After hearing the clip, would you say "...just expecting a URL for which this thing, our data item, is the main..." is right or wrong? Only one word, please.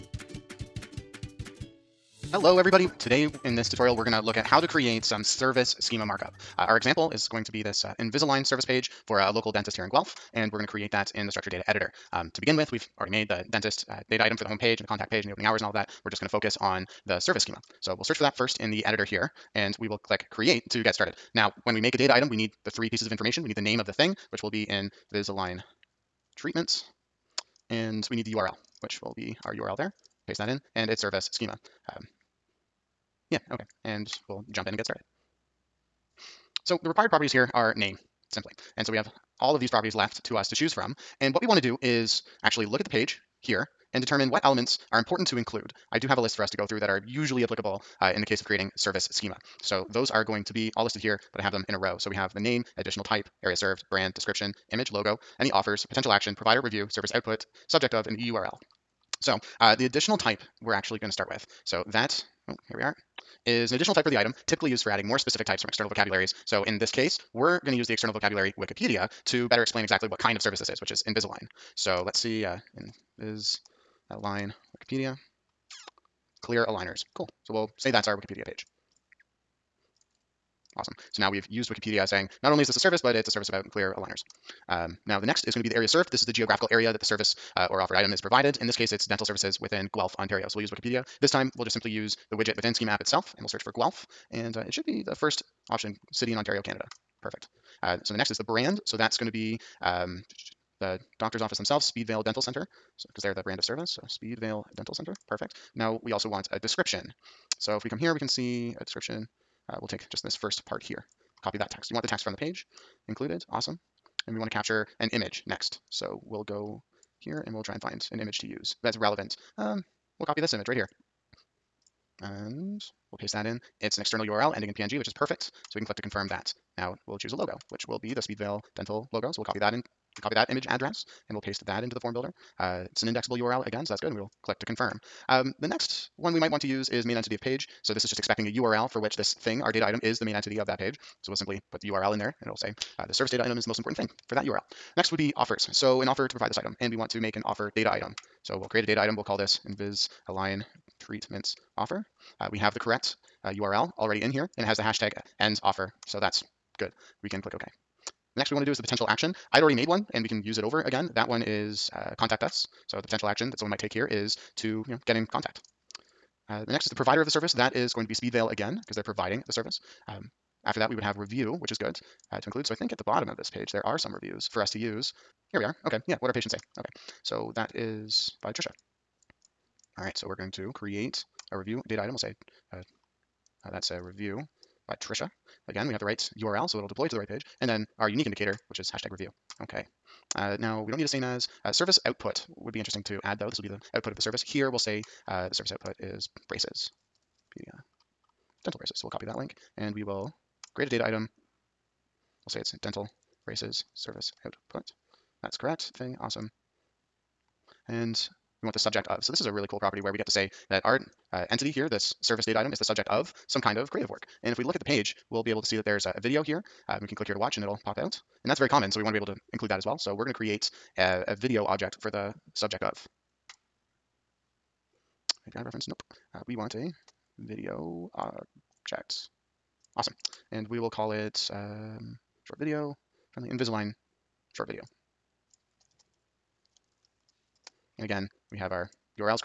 right.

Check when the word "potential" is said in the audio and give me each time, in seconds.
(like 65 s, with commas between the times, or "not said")
55 s, 158 s, 163 s.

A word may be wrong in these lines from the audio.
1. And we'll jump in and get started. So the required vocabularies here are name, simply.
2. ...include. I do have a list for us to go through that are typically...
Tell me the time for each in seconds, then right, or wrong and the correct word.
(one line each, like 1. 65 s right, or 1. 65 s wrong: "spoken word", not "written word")
1. 33 s wrong: "properties", not "vocabularies"
2. 45 s wrong: "usually", not "typically".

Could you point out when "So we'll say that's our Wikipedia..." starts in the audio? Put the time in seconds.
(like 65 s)
77 s.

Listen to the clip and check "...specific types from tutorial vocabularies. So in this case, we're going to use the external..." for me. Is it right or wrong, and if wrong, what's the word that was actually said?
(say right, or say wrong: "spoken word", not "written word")
wrong: "external", not "tutorial".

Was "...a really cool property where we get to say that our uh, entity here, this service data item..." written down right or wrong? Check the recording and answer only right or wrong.
right.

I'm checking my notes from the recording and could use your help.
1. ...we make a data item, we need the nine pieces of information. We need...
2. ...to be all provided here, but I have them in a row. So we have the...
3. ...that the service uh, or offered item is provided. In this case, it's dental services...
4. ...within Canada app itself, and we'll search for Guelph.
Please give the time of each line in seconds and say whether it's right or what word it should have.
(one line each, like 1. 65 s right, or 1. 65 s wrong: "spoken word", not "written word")
1. 21 s wrong: "three", not "nine"
2. 50 s wrong: "listed", not "provided"
3. 86 s right
4. 92 s wrong: "Schema", not "Canada".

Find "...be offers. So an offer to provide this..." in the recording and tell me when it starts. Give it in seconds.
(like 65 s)
145 s.